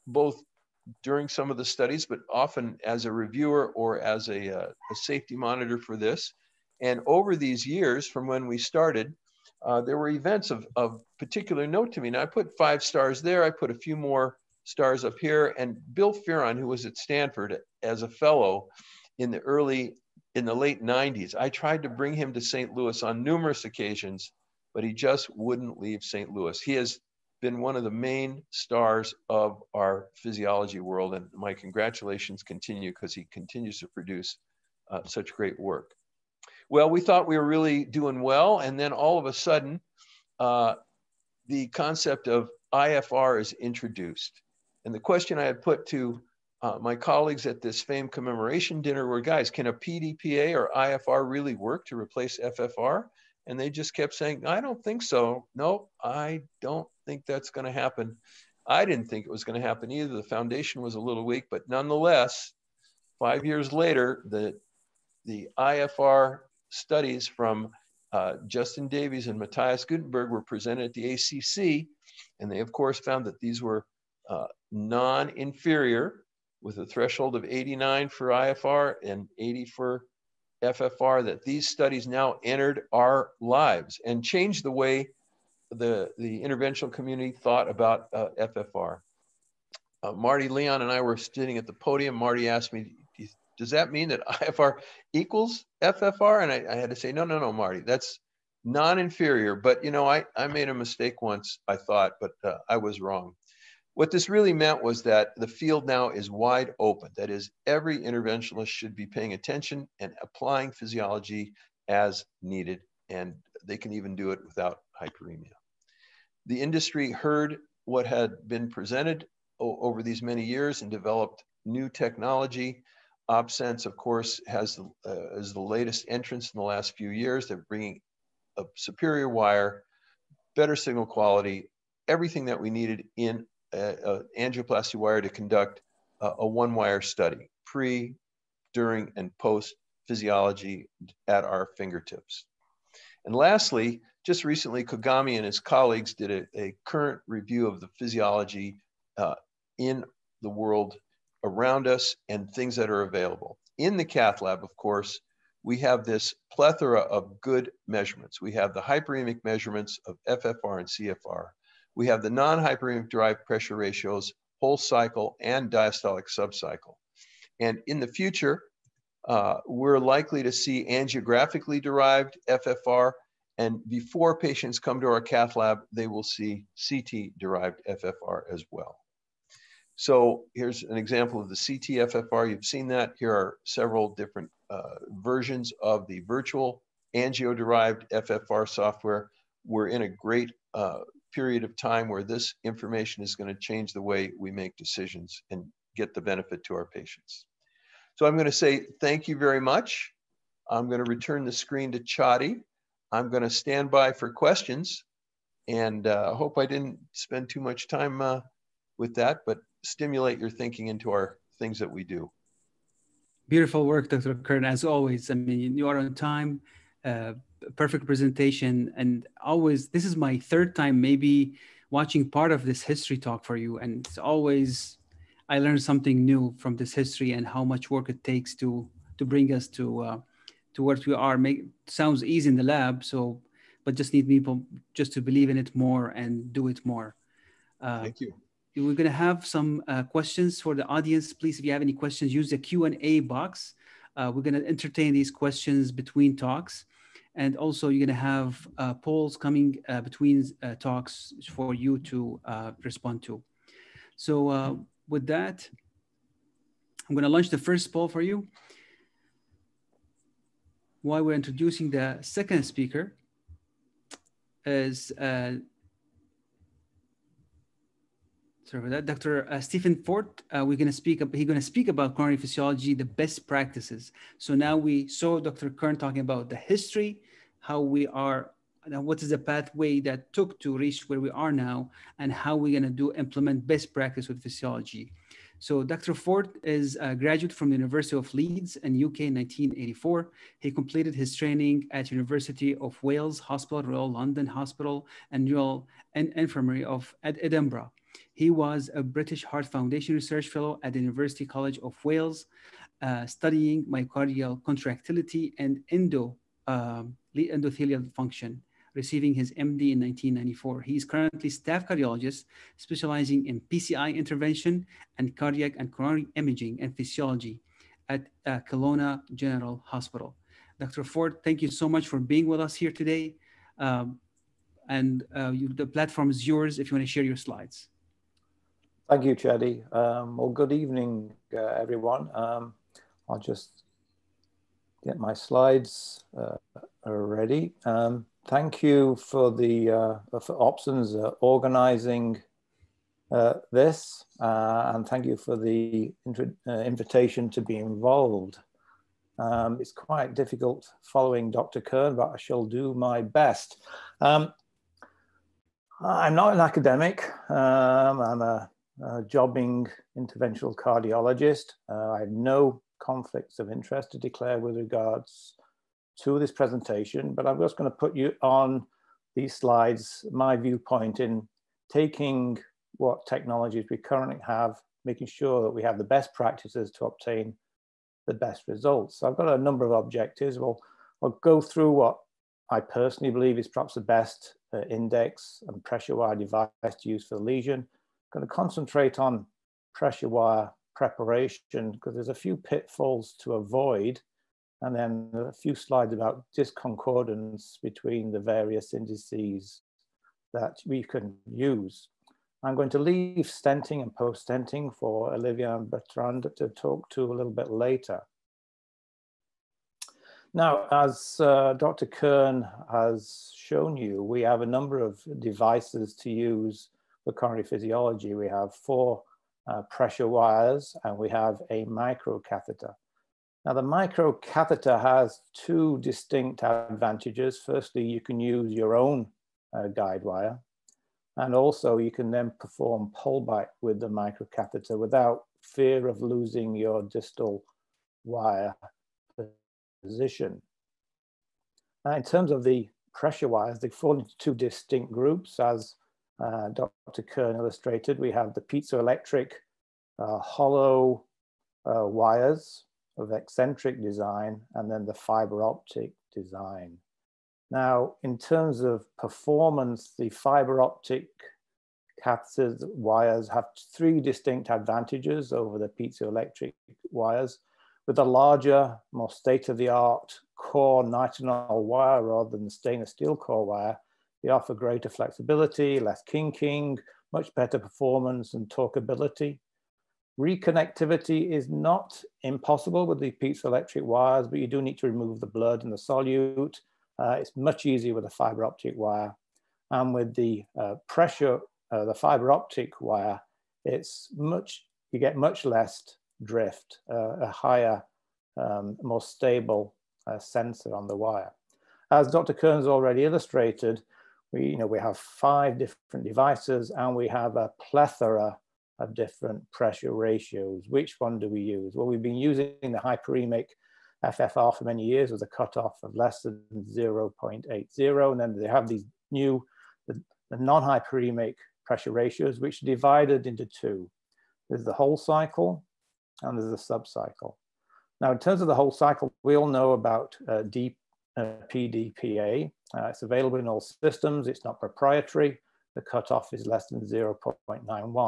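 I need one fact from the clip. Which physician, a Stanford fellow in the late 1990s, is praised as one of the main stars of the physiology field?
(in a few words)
Bill Fearon.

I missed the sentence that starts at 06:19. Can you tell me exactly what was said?
So I've got a number of objectives.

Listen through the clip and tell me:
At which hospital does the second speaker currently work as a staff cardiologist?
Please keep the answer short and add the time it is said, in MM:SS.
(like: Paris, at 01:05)
Kelowna General Hospital, at 05:18.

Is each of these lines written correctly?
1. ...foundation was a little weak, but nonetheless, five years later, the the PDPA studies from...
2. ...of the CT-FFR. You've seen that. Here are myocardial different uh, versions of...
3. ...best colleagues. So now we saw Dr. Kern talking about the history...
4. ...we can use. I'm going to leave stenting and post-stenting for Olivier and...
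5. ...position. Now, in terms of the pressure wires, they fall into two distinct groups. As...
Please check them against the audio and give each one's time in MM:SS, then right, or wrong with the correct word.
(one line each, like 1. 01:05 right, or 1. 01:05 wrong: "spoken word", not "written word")
1. 01:00 wrong: "IFR", not "PDPA"
2. 03:01 wrong: "several", not "myocardial"
3. 04:33 wrong: "practices", not "colleagues"
4. 06:40 right
5. 07:20 right.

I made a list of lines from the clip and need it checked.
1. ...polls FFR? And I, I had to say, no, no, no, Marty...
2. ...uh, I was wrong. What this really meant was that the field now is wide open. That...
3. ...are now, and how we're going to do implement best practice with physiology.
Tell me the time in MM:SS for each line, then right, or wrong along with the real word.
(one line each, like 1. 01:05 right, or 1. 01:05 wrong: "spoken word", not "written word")
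1. 01:35 wrong: "equals", not "polls"
2. 01:42 right
3. 04:41 right.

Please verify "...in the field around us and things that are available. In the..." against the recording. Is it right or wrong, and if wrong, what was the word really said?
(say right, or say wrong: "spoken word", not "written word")
wrong: "world", not "field".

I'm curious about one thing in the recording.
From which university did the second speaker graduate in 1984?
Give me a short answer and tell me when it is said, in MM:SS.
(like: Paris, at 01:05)
University of Leeds, at 04:47.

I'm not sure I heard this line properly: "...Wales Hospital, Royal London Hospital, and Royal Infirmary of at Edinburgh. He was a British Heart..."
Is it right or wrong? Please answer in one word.
right.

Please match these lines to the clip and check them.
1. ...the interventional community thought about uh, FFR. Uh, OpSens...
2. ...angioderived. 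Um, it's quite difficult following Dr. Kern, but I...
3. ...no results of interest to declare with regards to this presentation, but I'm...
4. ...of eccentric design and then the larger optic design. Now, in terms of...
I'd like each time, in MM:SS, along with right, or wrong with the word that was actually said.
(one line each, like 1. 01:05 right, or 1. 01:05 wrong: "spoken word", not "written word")
1. 01:26 wrong: "Marty", not "OpSens"
2. 05:47 wrong: "involved", not "angioderived"
3. 06:02 wrong: "conflicts", not "results"
4. 07:33 wrong: "fiber", not "larger".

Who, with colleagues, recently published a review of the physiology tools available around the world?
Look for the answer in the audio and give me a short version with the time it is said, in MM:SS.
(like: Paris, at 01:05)
Kogame, at 02:24.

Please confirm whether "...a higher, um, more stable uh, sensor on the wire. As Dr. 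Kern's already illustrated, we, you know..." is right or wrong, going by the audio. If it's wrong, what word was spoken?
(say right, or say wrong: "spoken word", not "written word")
right.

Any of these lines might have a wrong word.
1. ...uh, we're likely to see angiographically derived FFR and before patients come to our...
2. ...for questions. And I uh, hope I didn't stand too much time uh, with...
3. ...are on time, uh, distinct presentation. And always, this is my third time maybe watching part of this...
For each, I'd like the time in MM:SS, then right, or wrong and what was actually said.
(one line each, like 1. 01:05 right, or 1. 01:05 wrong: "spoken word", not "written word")
1. 02:49 right
2. 03:24 wrong: "spend", not "stand"
3. 03:35 wrong: "perfect", not "distinct".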